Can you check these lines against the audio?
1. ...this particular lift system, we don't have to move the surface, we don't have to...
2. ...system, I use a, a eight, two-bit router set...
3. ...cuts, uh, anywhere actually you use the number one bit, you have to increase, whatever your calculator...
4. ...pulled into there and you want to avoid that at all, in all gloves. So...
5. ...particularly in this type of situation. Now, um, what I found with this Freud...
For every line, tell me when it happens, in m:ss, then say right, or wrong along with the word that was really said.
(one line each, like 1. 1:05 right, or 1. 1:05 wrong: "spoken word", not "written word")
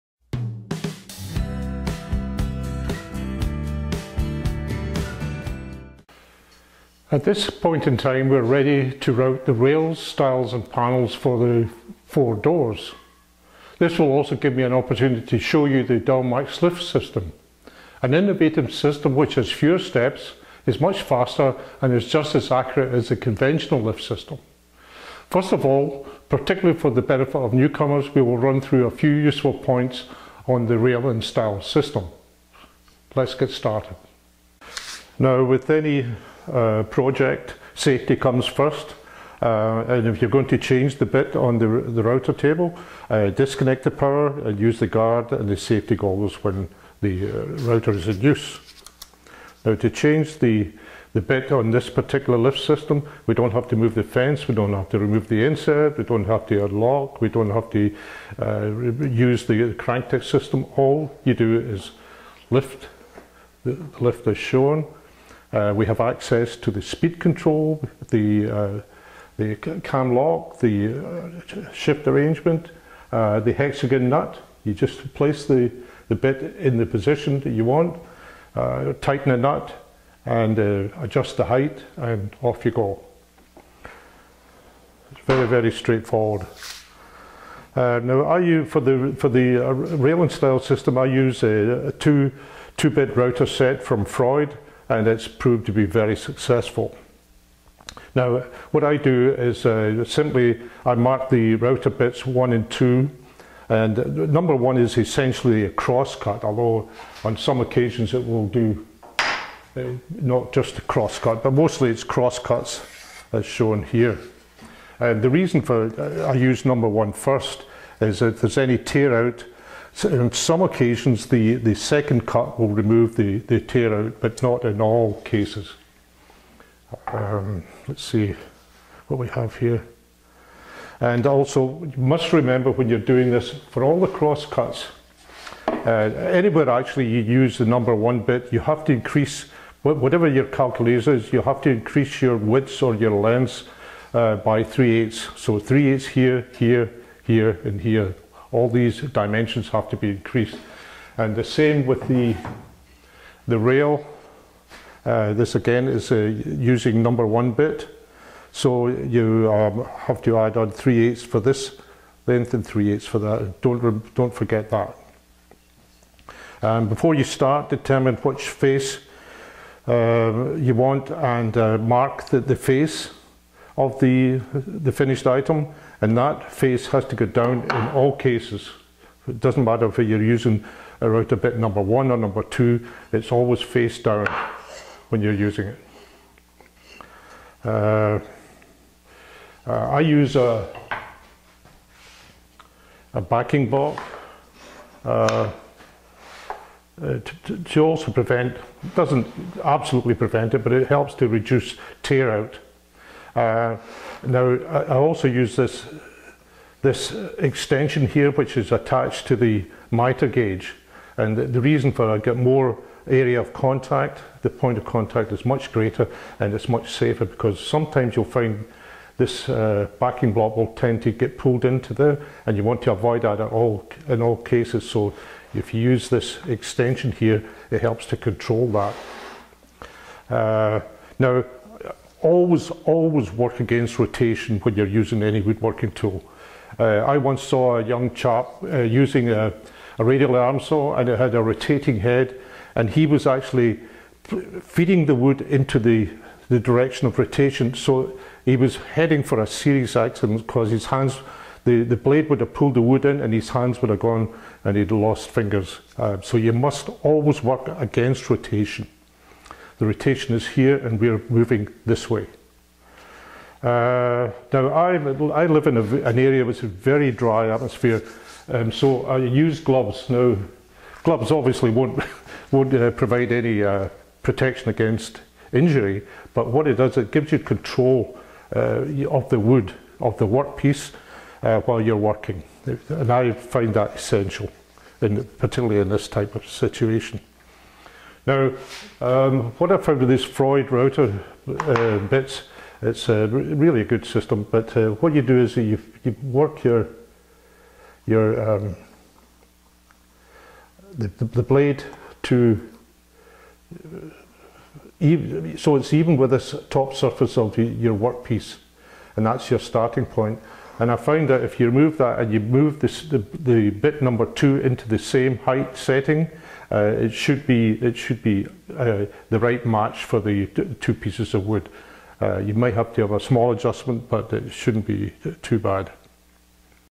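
1. 0:51 wrong: "fence", not "surface"
2. 1:30 wrong: "two", not "eight"
3. 2:14 right
4. 3:41 wrong: "cases", not "gloves"
5. 4:45 right.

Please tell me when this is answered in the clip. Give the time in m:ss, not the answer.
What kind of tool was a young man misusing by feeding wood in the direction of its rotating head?
4:00.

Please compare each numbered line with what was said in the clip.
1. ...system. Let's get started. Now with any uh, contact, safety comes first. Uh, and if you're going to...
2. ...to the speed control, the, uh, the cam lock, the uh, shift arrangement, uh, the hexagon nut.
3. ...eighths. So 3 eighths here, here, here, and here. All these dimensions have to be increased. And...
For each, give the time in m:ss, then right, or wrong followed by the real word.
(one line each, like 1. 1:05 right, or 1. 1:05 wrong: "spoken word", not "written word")
1. 0:31 wrong: "project", not "contact"
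2. 1:06 right
3. 2:24 right.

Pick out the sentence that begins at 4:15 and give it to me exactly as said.
Uh, so you must always work against rotation the rotation is here and we are moving this way.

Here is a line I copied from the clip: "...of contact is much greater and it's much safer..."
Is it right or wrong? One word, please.
right.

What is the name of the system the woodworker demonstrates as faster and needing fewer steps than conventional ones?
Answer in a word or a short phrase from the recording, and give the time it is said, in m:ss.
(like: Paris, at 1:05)
Dowelmax, at 0:15.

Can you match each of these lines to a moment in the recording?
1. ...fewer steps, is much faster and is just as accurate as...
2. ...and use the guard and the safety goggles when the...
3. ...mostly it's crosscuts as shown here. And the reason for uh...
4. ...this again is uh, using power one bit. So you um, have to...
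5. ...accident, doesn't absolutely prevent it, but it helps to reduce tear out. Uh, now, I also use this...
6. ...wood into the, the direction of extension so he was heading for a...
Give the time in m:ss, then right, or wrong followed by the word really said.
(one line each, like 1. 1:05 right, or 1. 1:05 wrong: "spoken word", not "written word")
1. 0:19 right
2. 0:44 right
3. 1:51 right
4. 2:35 wrong: "number", not "power"
5. 3:18 wrong: "prevent", not "accident"
6. 4:05 wrong: "rotation", not "extension".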